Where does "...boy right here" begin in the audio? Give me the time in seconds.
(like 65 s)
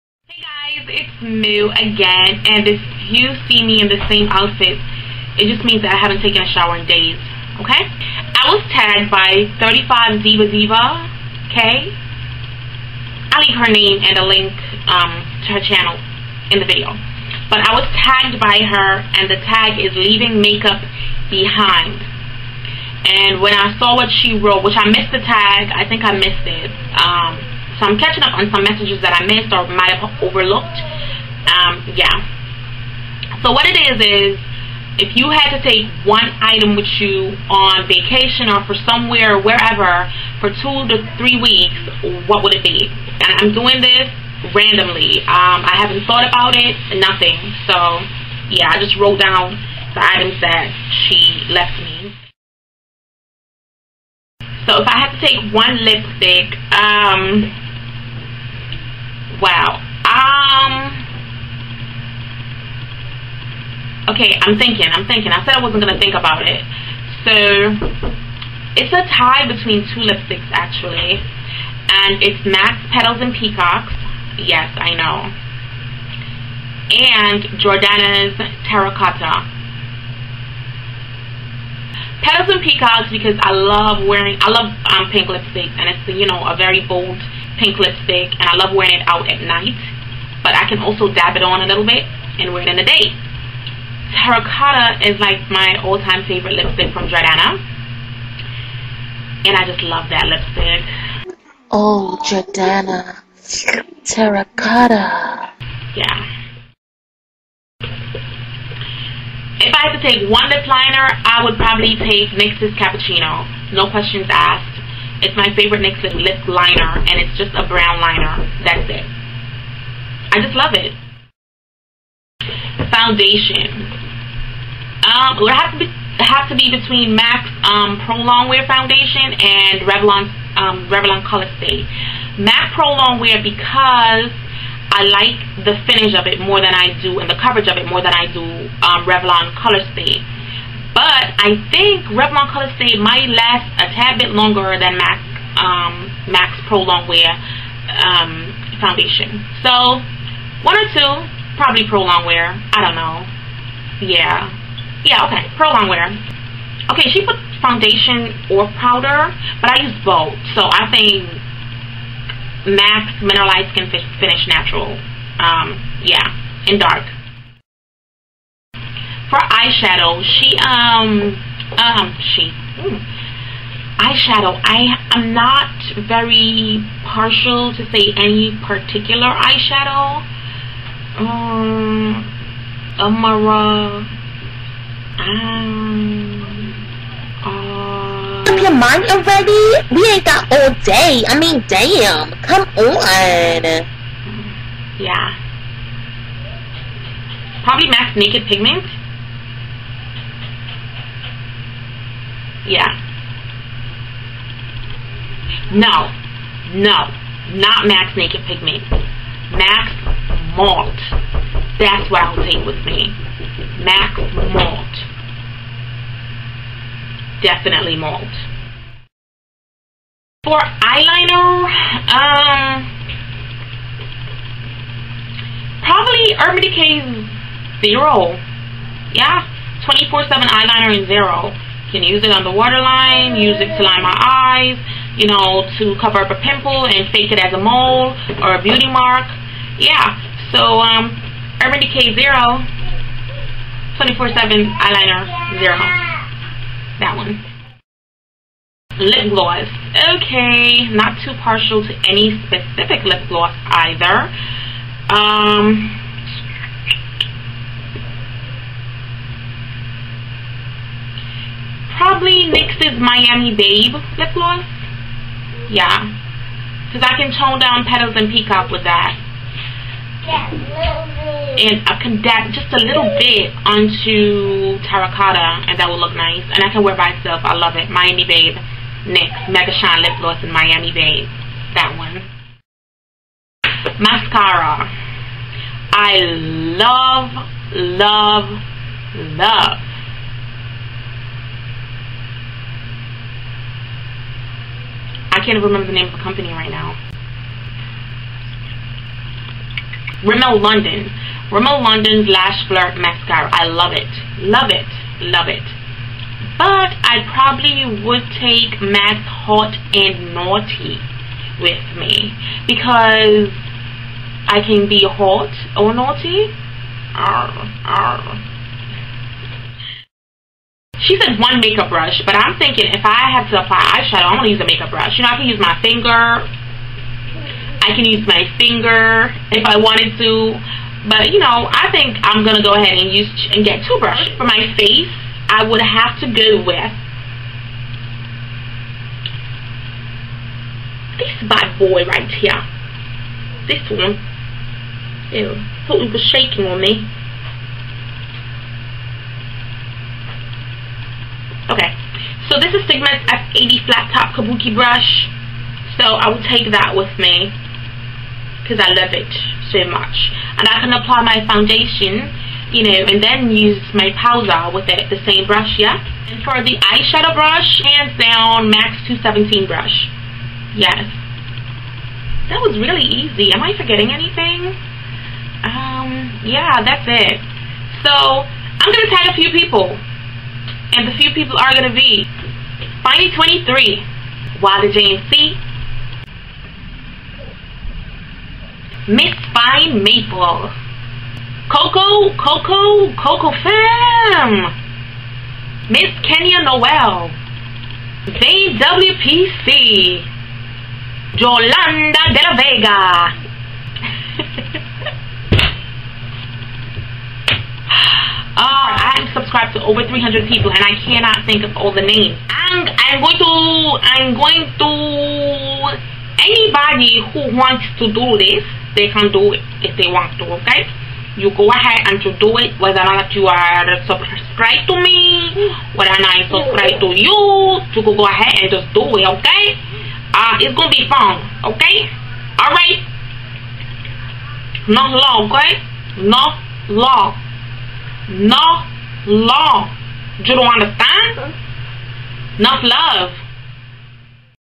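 341 s.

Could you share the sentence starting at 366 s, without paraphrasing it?
And for the eyeshadow brush, hands down, MAC's 217 brush.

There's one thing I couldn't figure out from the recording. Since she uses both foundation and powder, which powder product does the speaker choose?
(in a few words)
MAC Mineralized Skin Finish Natural.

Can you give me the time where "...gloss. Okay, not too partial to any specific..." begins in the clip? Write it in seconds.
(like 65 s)
249 s.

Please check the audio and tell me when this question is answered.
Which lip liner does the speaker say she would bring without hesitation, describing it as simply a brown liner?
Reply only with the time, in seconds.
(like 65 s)
112 s.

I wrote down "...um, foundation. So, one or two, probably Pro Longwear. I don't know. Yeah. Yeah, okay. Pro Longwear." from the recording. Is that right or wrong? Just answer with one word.
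right.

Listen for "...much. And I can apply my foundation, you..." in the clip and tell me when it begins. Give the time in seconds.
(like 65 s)
359 s.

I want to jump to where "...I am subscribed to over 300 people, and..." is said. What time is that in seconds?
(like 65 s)
409 s.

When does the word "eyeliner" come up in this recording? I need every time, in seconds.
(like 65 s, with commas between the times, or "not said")
220 s, 230 s, 244 s.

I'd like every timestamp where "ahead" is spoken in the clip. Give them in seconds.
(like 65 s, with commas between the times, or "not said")
332 s, 421 s, 428 s.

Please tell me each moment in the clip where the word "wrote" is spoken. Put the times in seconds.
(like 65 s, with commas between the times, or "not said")
24 s, 49 s.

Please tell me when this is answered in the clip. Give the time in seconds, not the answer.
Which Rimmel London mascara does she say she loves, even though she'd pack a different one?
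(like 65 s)
302 s.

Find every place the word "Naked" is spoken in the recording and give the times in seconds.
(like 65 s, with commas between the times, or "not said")
198 s, 208 s.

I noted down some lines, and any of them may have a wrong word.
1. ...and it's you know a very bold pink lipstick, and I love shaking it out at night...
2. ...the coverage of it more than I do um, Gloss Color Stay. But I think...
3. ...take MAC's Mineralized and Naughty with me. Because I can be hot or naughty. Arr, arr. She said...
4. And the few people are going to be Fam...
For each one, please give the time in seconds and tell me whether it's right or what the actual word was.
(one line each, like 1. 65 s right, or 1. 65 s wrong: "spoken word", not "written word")
1. 85 s wrong: "wearing", not "shaking"
2. 137 s wrong: "Revlon", not "Gloss"
3. 308 s wrong: "Haute", not "Mineralized"
4. 380 s wrong: "Finally", not "Fam".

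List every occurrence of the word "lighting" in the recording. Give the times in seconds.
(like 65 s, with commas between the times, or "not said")
not said.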